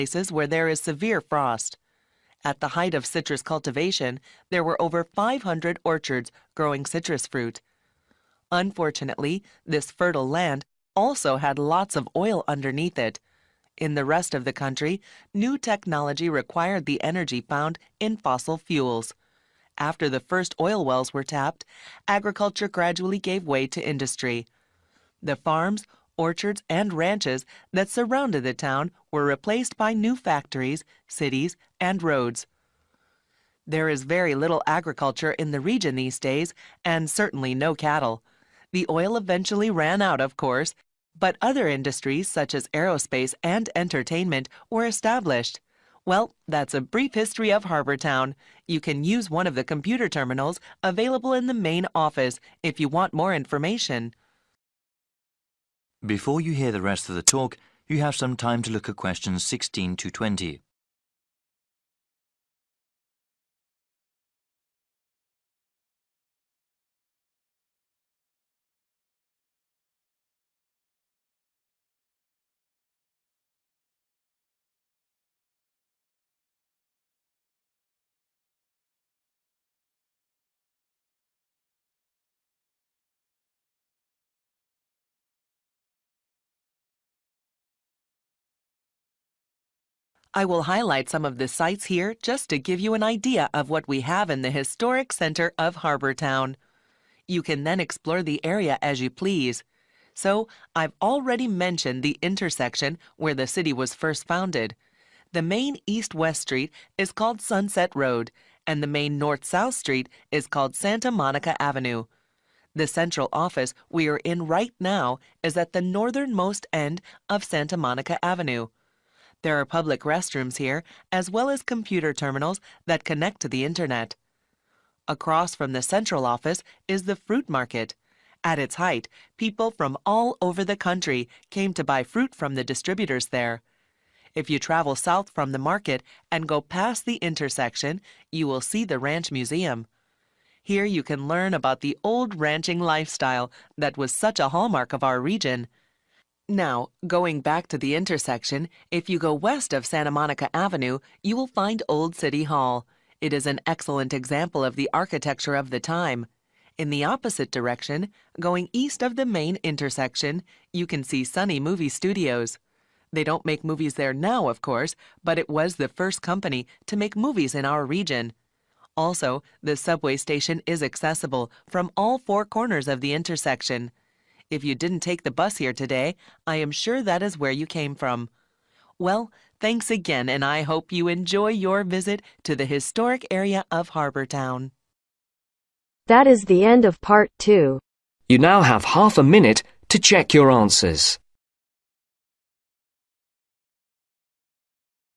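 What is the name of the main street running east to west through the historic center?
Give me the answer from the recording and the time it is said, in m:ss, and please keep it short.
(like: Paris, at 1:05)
Sunset Road, at 1:47.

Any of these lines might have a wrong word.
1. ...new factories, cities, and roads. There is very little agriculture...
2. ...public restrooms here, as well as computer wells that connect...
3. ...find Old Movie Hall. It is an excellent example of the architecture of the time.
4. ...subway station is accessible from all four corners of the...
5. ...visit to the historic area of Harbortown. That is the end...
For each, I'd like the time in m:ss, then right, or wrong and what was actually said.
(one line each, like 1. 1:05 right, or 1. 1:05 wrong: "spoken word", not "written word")
1. 0:29 right
2. 1:59 wrong: "terminals", not "wells"
3. 2:31 wrong: "City", not "Movie"
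4. 2:49 right
5. 3:01 right.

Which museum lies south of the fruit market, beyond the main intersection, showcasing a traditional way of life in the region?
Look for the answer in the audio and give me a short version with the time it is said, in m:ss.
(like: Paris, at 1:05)
Ranch Museum, at 2:18.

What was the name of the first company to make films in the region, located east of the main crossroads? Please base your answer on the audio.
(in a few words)
Sunny Movie Studios.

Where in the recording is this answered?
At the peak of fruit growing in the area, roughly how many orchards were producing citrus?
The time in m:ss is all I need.
0:04.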